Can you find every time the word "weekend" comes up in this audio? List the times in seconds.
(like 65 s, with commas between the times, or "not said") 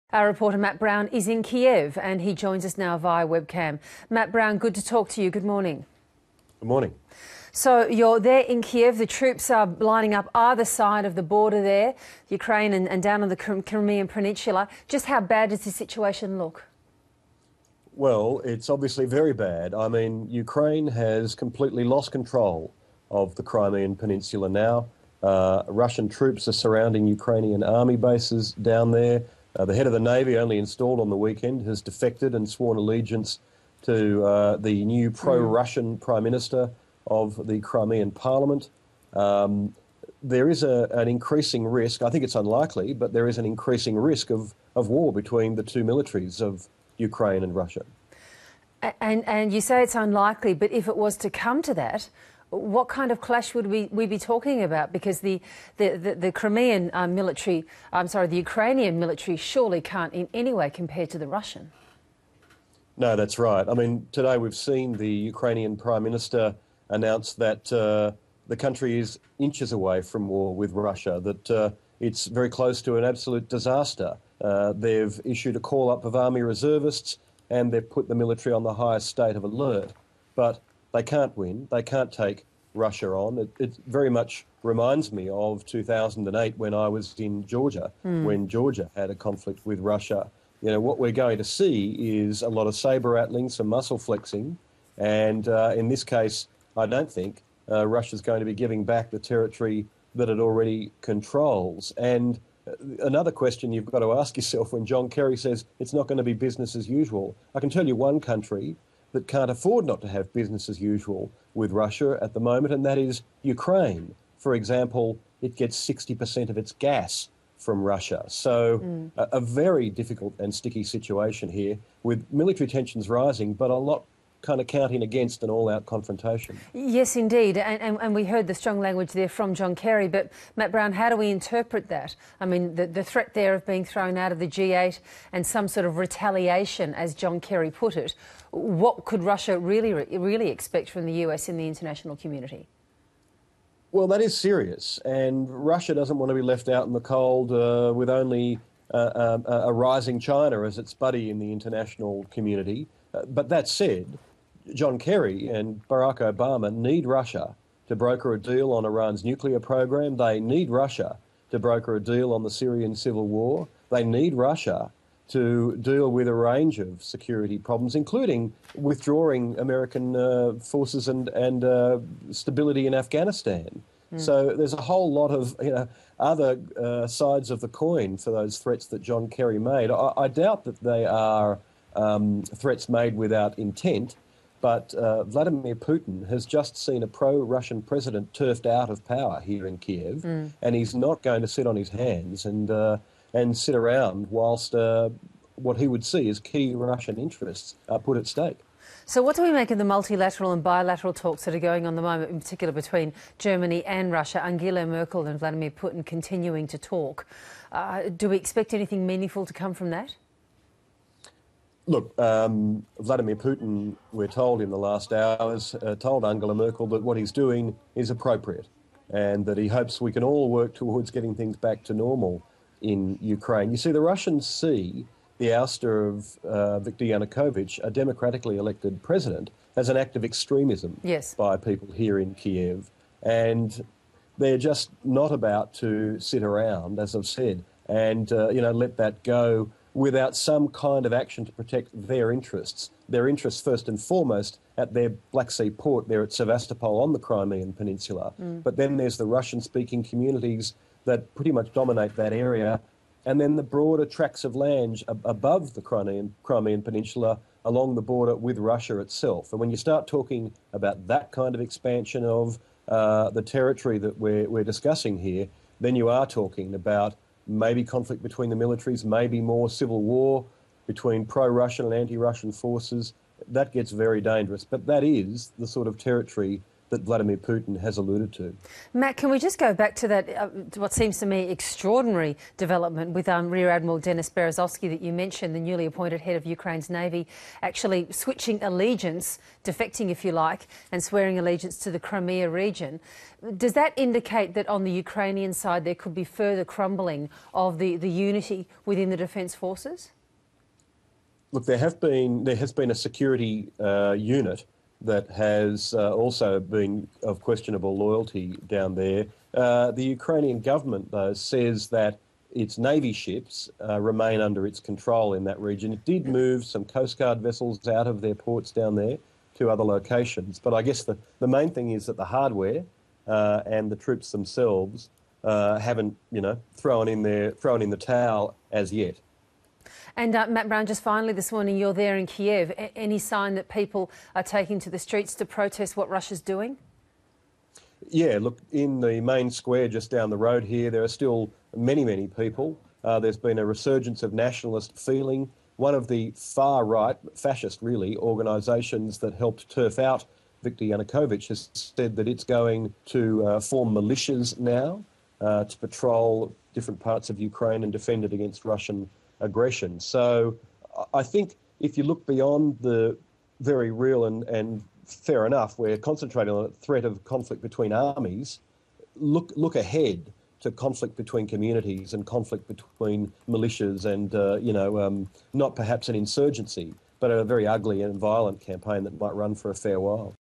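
31 s.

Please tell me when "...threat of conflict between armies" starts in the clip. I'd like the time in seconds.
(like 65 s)
366 s.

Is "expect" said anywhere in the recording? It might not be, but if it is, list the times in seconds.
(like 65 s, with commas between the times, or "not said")
140 s, 208 s.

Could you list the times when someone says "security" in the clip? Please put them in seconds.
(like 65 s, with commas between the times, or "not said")
167 s, 302 s.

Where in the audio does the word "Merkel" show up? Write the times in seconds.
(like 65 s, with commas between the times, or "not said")
204 s, 216 s.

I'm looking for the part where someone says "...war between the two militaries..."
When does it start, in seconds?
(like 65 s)
44 s.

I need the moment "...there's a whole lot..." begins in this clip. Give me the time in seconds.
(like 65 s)
174 s.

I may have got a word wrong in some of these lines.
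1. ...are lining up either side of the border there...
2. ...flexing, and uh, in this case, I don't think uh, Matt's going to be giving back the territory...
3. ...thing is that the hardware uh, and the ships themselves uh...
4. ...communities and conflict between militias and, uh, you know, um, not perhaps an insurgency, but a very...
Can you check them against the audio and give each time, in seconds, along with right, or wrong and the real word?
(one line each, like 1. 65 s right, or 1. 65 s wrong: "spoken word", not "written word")
1. 9 s right
2. 93 s wrong: "Russia", not "Matt"
3. 321 s wrong: "troops", not "ships"
4. 371 s right.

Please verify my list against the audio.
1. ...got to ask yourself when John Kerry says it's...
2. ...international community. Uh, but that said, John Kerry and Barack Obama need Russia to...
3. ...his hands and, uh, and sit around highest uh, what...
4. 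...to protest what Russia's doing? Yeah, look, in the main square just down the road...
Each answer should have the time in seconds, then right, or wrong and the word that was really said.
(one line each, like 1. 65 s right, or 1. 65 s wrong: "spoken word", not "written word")
1. 103 s right
2. 151 s right
3. 191 s wrong: "whilst", not "highest"
4. 335 s right.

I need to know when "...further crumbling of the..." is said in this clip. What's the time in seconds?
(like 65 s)
296 s.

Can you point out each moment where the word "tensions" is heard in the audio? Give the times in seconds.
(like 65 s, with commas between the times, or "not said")
122 s.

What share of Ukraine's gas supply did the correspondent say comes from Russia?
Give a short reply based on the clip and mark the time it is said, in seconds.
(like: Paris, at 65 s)
60%, at 115 s.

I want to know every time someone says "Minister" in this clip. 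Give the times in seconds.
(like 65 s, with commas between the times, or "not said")
36 s, 66 s.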